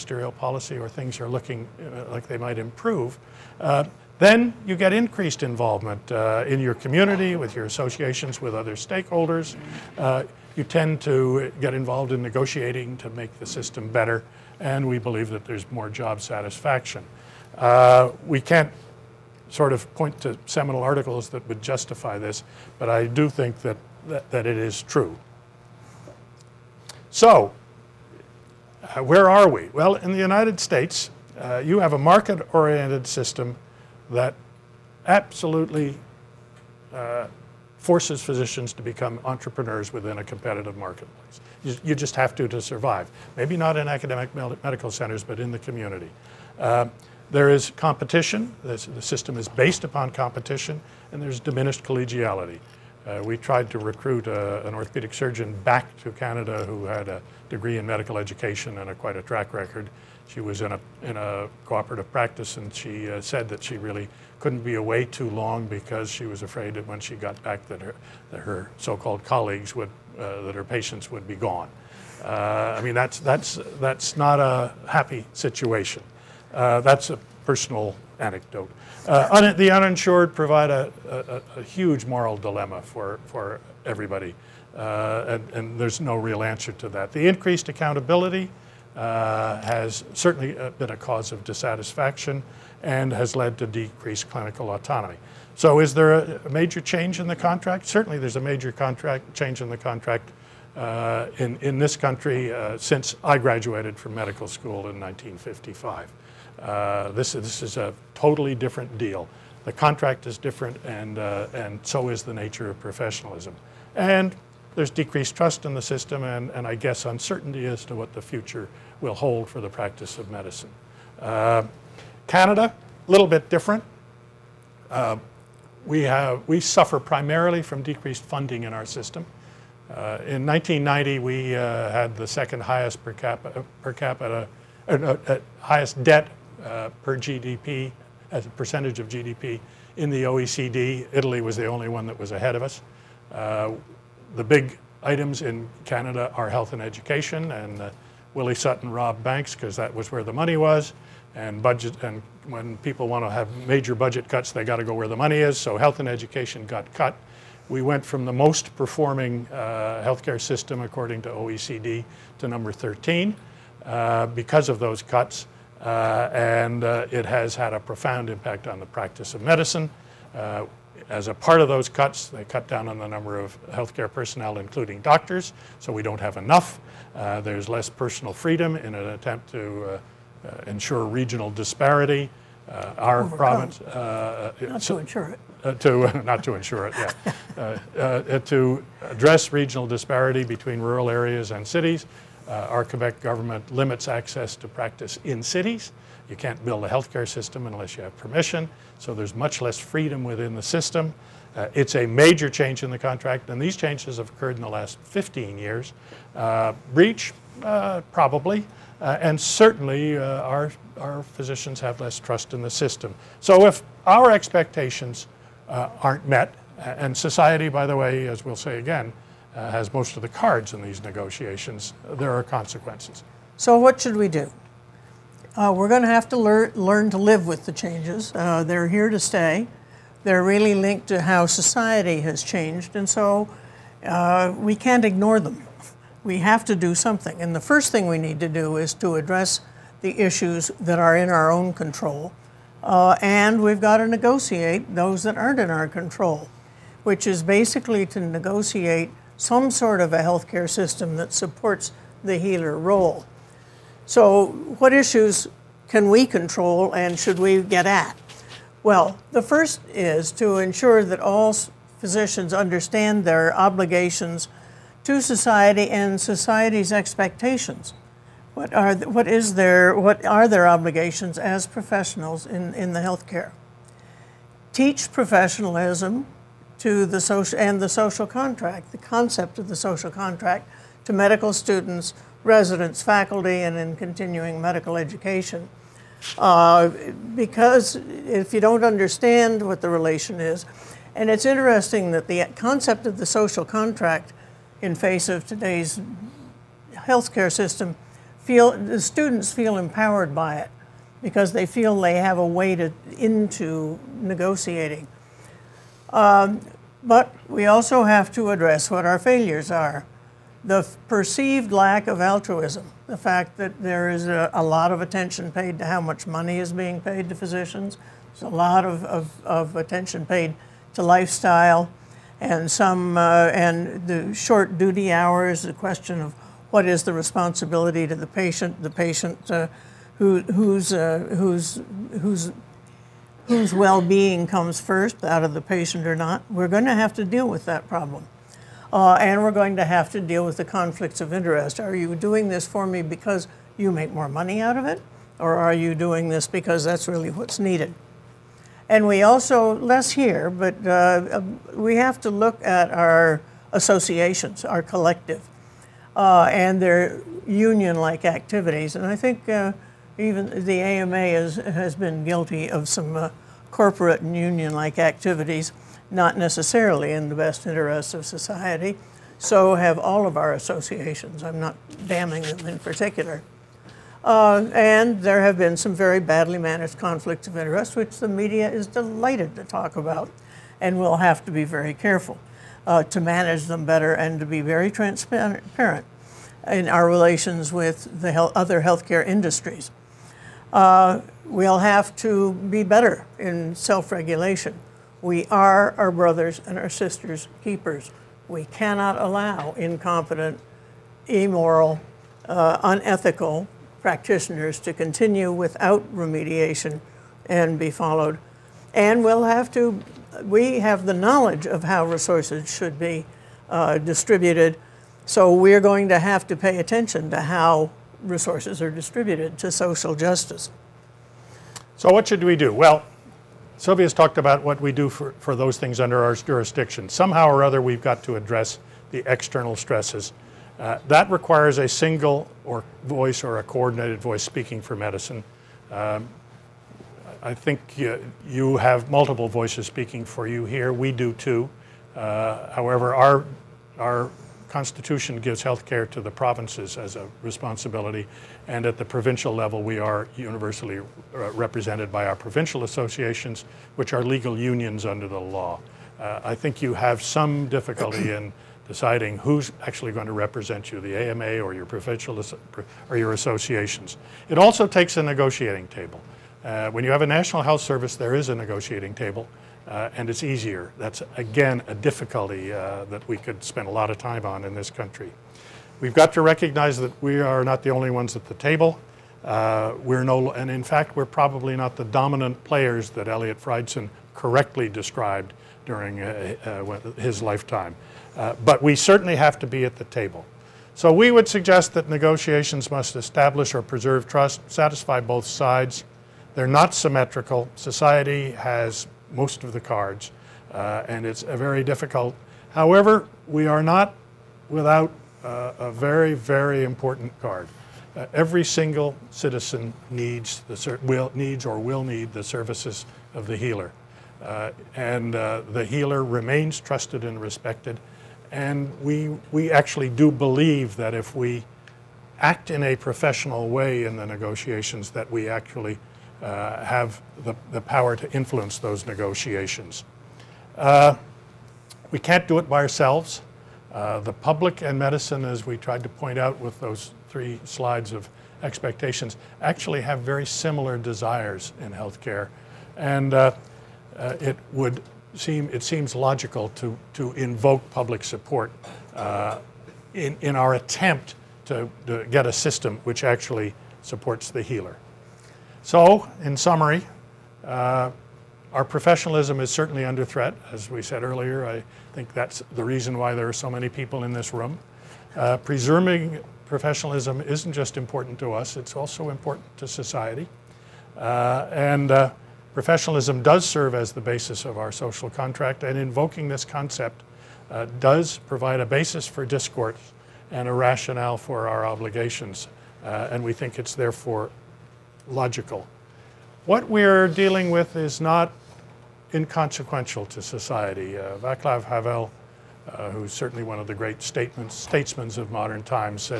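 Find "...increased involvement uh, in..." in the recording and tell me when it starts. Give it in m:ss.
0:04.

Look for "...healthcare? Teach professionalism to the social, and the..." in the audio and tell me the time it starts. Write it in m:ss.
4:32.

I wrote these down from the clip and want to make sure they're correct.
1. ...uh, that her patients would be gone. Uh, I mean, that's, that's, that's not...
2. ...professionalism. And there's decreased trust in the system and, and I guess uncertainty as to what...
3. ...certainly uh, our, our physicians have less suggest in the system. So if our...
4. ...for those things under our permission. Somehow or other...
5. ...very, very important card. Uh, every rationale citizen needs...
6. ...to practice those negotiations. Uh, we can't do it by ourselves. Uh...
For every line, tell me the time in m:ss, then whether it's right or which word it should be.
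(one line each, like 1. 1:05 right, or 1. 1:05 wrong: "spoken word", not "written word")
1. 1:10 right
2. 1:52 right
3. 3:29 wrong: "trust", not "suggest"
4. 7:05 wrong: "jurisdiction", not "permission"
5. 8:25 wrong: "single", not "rationale"
6. 8:48 wrong: "influence", not "practice".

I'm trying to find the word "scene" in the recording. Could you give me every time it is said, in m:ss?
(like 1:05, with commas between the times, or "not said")
not said.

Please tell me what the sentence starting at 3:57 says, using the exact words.
And the first thing we need to do is to address the issues that are in our own control.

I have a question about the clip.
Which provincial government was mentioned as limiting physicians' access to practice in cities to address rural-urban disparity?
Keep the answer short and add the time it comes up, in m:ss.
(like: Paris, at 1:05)
Quebec, at 3:12.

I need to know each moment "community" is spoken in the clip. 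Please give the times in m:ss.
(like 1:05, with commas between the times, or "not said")
0:06, 0:45.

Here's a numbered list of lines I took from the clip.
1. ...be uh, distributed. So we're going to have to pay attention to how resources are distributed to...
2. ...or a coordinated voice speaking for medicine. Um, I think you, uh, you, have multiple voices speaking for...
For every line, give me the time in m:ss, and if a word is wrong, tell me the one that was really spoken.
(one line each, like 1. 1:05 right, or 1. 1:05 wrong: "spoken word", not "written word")
1. 6:52 right
2. 7:13 right.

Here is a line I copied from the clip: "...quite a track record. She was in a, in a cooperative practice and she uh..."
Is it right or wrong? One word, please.
right.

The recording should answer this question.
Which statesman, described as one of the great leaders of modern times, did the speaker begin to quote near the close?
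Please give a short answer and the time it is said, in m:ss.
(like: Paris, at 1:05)
Vaclav Havel, at 9:51.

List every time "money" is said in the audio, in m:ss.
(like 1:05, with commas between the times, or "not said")
2:30, 2:35, 5:16, 5:44.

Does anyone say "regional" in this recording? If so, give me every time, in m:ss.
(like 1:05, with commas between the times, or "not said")
3:01, 3:09.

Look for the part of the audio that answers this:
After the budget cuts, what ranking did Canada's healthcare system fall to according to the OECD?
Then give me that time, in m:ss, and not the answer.
2:42.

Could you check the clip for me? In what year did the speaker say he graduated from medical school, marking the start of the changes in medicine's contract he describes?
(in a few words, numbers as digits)
1955.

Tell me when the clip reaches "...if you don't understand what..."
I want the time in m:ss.
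4:47.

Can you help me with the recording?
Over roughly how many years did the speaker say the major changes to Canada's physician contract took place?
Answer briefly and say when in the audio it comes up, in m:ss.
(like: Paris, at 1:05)
15 years, at 3:25.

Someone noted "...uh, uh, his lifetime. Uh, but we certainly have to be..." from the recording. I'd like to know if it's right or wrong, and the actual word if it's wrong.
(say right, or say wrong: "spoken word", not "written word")
right.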